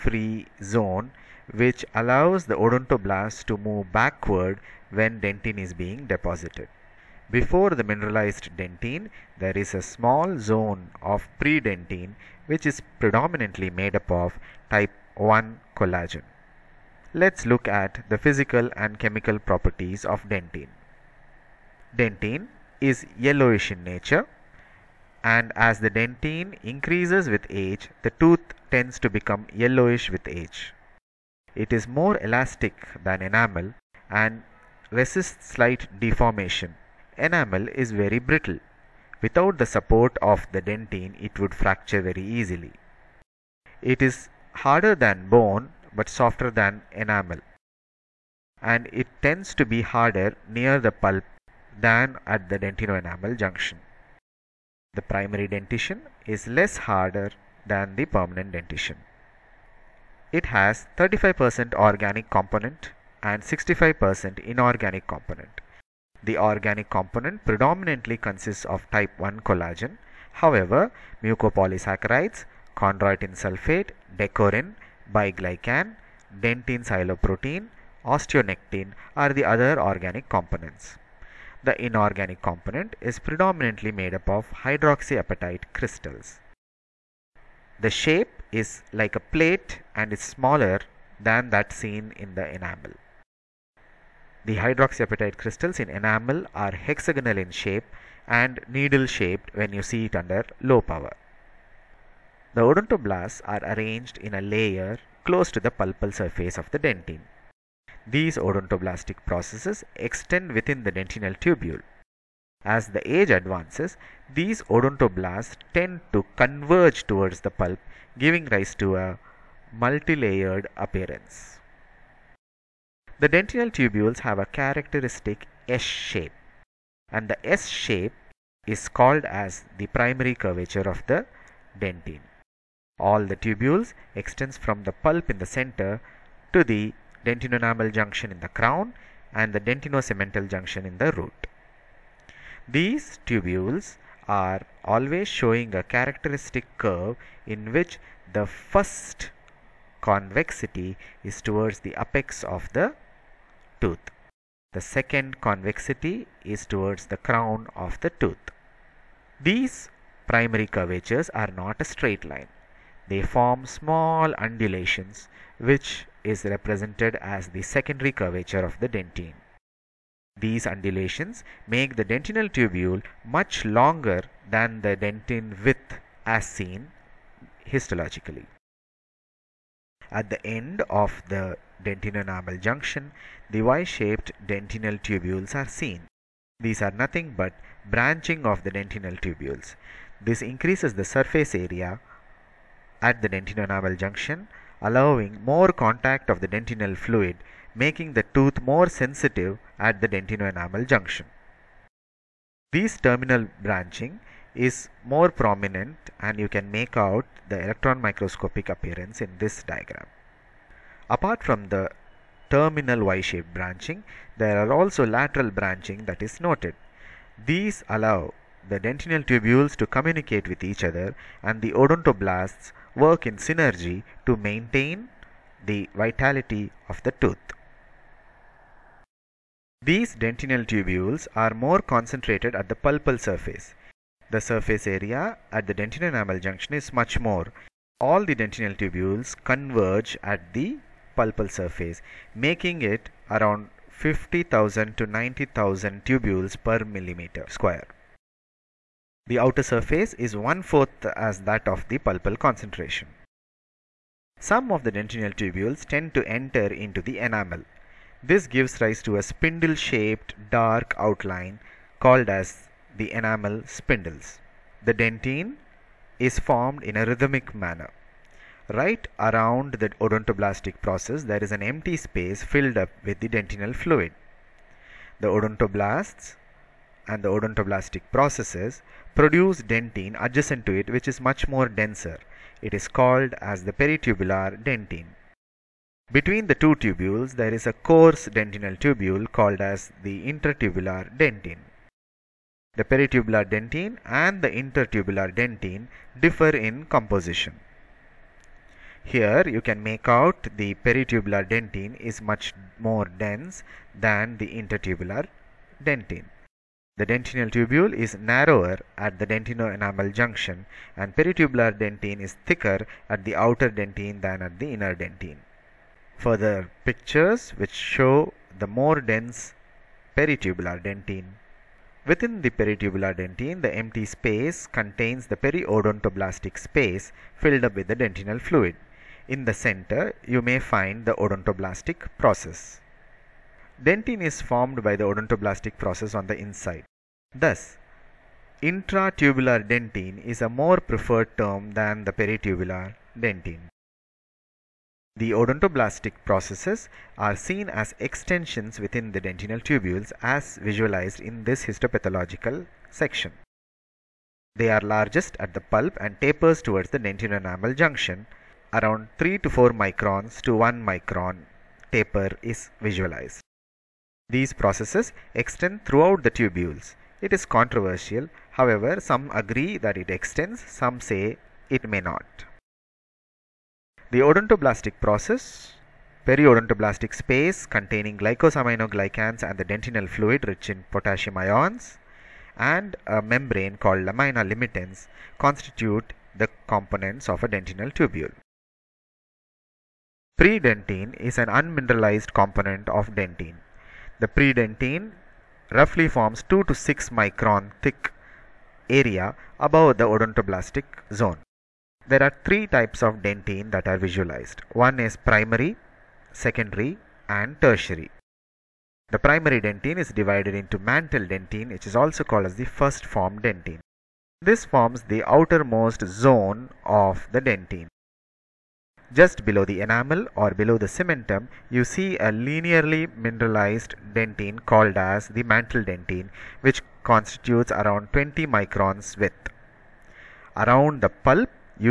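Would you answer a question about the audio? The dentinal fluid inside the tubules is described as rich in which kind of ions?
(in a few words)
potassium.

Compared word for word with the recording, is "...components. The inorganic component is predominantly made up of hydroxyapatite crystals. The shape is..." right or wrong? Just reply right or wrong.
right.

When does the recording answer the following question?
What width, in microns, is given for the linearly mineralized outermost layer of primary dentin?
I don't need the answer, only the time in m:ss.
7:08.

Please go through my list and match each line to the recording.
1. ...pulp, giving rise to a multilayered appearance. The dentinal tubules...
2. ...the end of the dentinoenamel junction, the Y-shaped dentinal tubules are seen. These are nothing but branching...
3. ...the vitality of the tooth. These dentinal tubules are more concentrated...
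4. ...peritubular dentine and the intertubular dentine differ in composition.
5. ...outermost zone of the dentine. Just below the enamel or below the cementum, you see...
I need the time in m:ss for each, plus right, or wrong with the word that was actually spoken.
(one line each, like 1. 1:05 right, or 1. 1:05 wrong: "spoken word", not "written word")
1. 1:57 right
2. 3:00 right
3. 3:45 right
4. 4:52 right
5. 6:55 right.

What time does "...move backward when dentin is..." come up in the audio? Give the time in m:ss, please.
0:03.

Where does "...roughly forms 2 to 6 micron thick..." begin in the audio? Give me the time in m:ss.
6:35.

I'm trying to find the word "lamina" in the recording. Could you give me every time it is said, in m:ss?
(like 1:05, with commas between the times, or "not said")
6:24.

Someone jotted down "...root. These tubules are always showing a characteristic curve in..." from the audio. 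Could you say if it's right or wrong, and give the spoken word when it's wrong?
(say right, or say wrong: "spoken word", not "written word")
right.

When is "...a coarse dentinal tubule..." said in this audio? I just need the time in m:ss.
4:47.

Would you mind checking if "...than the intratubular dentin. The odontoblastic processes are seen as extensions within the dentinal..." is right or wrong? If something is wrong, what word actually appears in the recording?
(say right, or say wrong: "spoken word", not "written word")
wrong: "peritubular", not "intratubular".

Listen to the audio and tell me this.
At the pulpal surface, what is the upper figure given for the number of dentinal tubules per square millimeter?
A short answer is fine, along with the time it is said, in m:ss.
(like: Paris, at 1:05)
90,000, at 4:05.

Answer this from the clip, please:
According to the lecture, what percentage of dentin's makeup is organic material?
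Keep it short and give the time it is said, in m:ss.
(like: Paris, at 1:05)
35%, at 1:00.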